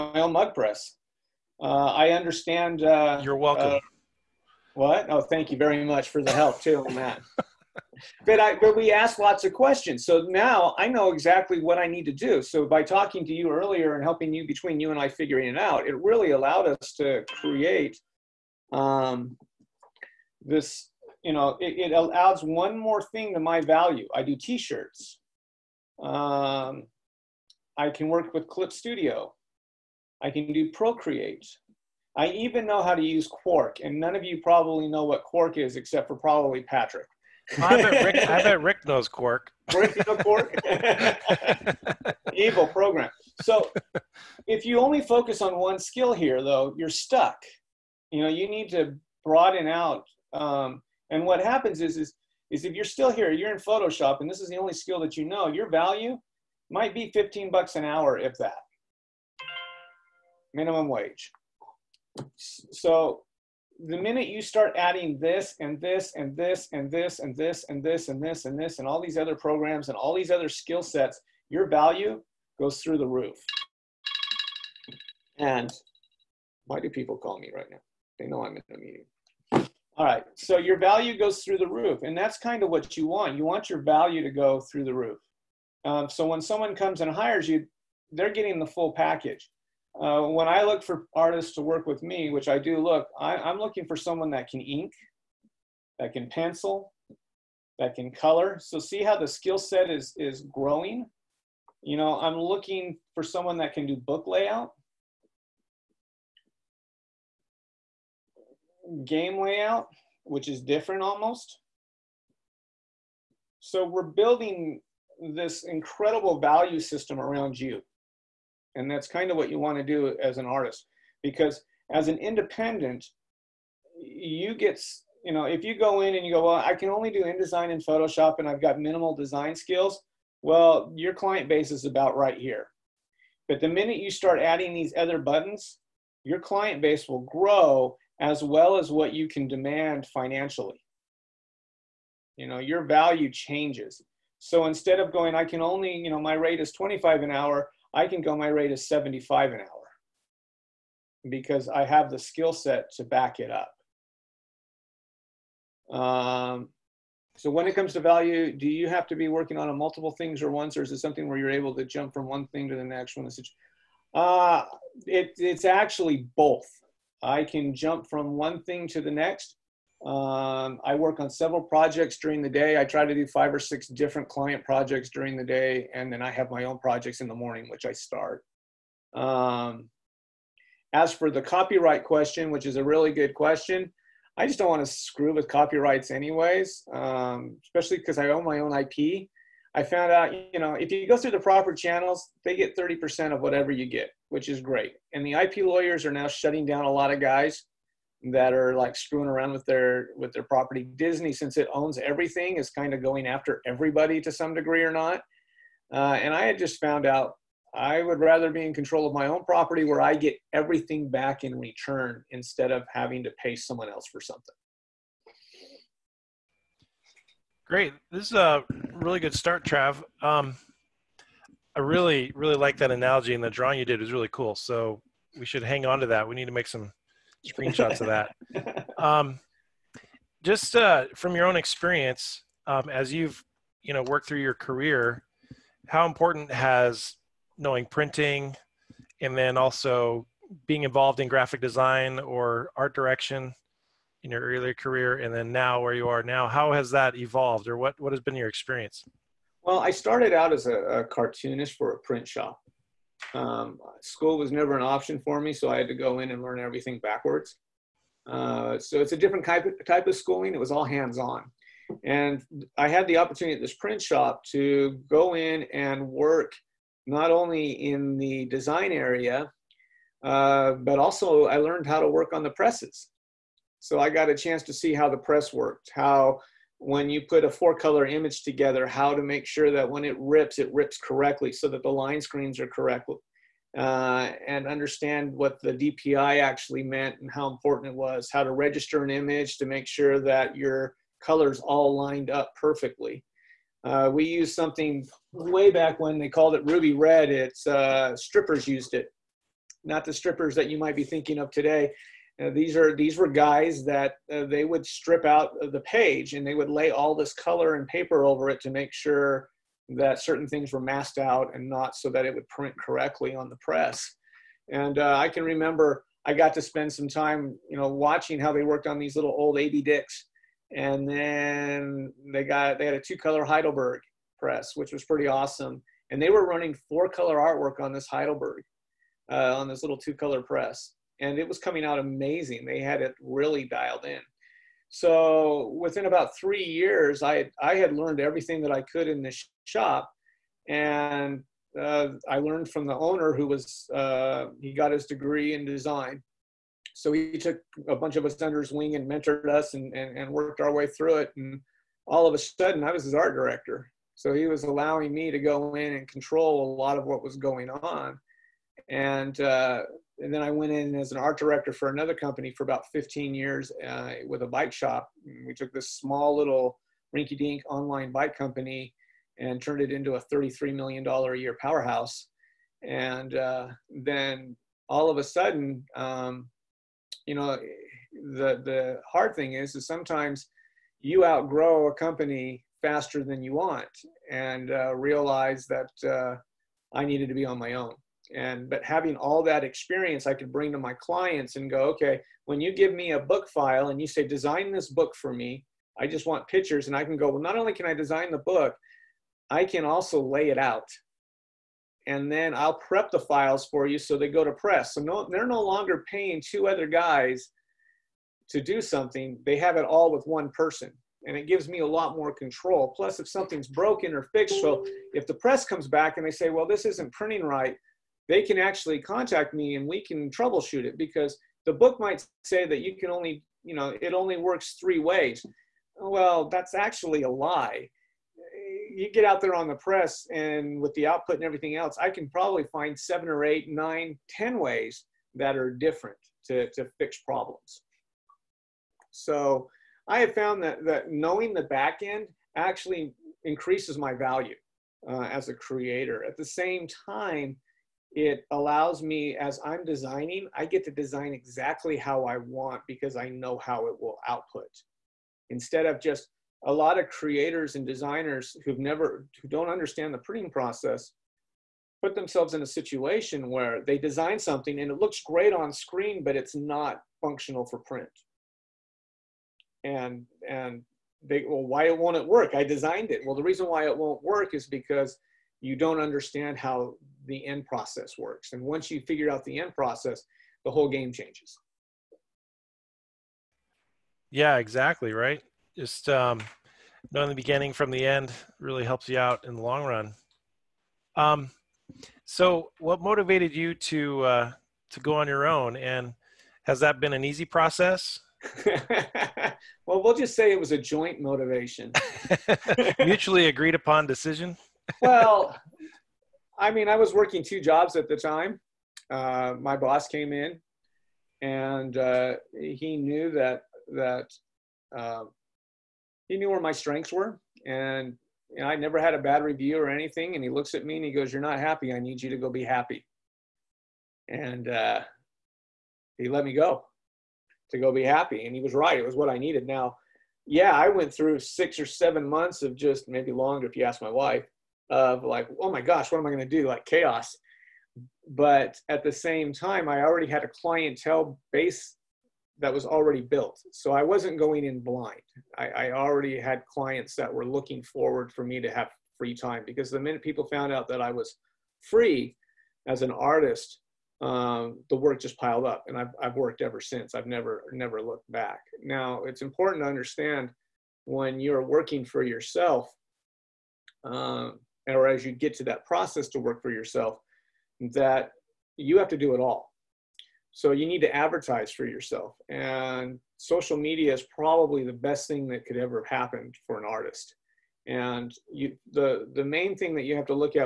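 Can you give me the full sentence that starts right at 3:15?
And the IP lawyers are now shutting down a lot of guys that are like screwing around with their with their property.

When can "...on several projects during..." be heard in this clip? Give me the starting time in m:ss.
2:51.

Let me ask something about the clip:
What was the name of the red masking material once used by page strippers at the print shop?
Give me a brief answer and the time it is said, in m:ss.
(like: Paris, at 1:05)
Ruby Red, at 4:56.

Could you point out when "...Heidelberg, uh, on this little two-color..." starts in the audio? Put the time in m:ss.
5:28.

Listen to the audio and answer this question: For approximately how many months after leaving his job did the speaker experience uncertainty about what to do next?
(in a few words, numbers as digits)
6 or 7 months.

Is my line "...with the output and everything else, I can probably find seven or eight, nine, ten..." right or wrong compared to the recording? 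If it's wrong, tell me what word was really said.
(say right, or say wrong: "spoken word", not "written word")
right.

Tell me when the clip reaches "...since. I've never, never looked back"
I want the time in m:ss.
9:16.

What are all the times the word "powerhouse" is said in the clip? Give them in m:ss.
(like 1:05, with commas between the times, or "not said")
6:11.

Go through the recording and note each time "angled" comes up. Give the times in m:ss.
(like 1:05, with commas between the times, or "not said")
not said.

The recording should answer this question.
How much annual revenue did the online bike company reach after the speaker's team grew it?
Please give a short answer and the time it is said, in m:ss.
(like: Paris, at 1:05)
33 million dollars, at 6:10.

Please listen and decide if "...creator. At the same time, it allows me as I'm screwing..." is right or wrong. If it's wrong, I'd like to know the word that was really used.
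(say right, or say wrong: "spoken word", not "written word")
wrong: "designing", not "screwing".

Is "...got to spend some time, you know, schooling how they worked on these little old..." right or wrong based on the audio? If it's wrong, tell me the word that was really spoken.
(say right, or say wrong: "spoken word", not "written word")
wrong: "watching", not "schooling".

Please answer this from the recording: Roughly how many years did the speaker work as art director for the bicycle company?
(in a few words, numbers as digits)
15.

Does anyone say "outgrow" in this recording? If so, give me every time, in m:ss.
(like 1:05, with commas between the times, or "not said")
6:21.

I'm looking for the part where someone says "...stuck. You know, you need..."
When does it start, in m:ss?
0:46.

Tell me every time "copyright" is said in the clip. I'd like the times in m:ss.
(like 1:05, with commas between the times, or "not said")
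3:01, 3:05.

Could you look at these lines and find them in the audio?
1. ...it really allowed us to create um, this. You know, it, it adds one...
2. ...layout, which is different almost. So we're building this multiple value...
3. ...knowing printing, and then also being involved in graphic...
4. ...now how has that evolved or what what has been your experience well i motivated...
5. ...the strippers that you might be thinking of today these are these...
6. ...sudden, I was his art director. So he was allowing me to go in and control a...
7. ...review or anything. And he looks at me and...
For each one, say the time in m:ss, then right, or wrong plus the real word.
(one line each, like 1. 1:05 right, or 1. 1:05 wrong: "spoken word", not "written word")
1. 0:15 right
2. 1:49 wrong: "incredible", not "multiple"
3. 3:57 right
4. 4:06 wrong: "started", not "motivated"
5. 5:00 right
6. 5:52 right
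7. 8:39 right.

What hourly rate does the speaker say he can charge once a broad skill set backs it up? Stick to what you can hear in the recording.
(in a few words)
75.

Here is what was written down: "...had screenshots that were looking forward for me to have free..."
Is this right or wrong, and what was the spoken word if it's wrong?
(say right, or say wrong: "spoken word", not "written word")
wrong: "clients", not "screenshots".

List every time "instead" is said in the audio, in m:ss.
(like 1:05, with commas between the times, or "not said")
2:24, 3:32, 7:35.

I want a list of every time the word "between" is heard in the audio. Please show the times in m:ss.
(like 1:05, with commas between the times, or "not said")
0:14.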